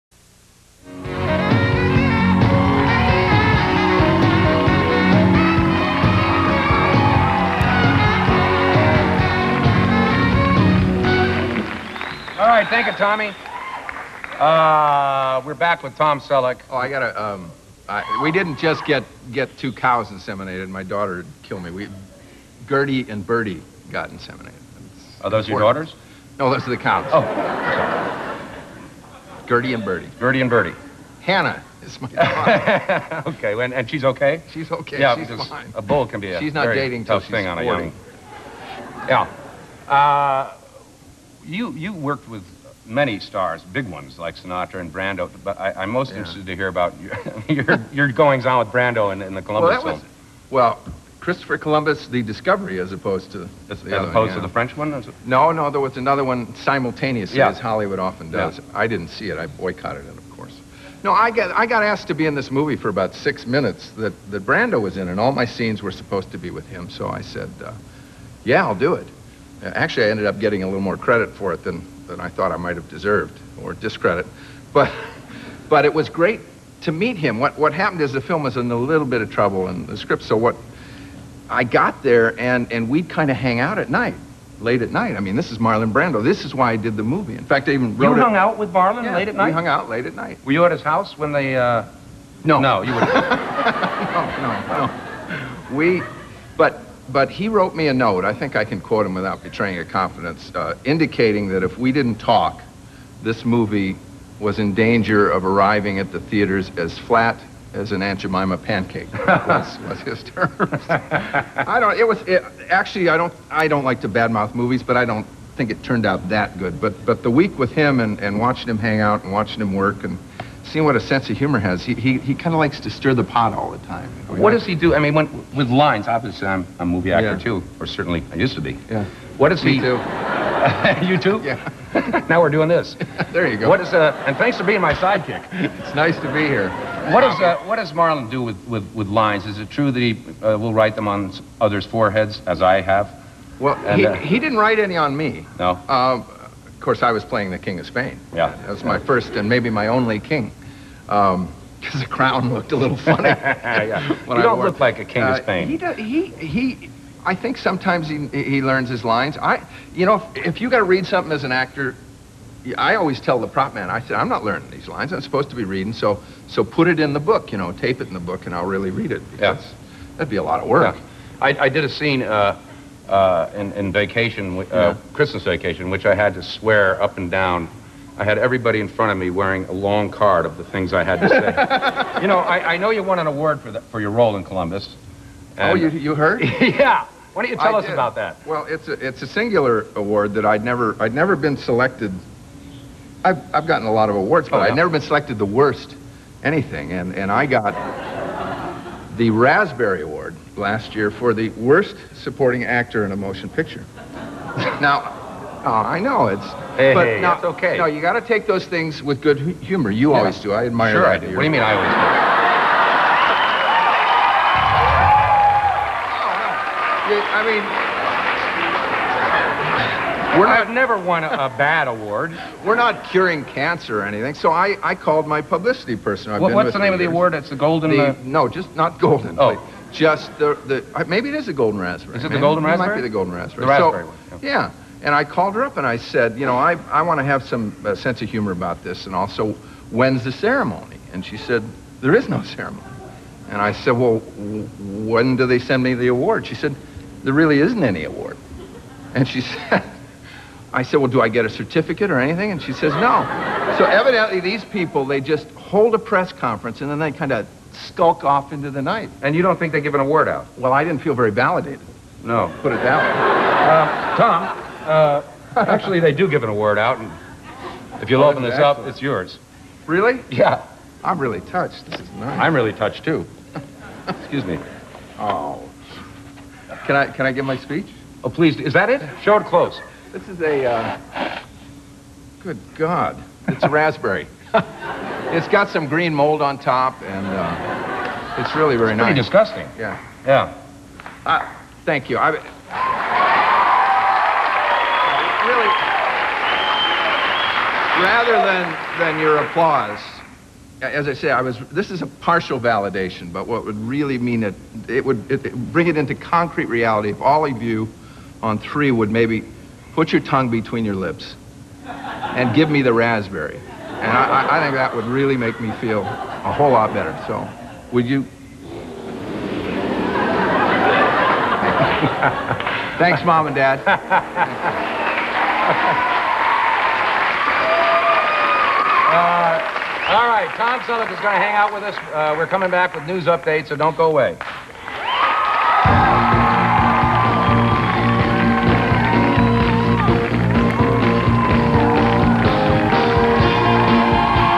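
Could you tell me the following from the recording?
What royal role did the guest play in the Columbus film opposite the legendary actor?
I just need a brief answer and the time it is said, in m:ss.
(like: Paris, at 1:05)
King of Spain, at 2:27.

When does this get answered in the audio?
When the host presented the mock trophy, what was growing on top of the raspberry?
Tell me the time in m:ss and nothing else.
4:45.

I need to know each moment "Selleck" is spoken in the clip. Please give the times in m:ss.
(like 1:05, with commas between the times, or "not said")
0:16, 5:30.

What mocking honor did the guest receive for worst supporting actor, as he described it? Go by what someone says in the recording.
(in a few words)
Raspberry Award.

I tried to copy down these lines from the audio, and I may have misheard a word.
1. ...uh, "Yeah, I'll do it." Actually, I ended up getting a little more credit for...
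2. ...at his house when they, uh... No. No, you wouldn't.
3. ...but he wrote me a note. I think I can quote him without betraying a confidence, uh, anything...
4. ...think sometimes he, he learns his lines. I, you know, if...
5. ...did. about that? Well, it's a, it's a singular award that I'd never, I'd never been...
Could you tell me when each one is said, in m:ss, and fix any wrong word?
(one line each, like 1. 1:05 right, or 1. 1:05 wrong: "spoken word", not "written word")
1. 1:07 right
2. 1:30 right
3. 1:37 wrong: "indicating", not "anything"
4. 2:37 right
5. 3:07 right.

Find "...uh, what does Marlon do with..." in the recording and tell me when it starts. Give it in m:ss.
2:17.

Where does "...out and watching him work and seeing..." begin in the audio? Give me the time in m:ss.
1:58.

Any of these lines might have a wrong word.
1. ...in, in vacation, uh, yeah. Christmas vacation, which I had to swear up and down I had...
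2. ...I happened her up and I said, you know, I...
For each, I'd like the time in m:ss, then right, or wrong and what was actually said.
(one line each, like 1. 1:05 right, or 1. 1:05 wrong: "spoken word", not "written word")
1. 2:53 right
2. 3:55 wrong: "called", not "happened".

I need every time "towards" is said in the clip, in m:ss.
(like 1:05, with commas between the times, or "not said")
not said.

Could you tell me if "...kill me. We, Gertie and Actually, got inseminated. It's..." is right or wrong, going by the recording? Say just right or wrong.
wrong.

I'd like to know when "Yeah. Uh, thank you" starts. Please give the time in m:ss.
4:50.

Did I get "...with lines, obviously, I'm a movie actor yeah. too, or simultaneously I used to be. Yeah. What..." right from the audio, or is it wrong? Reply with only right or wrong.
wrong.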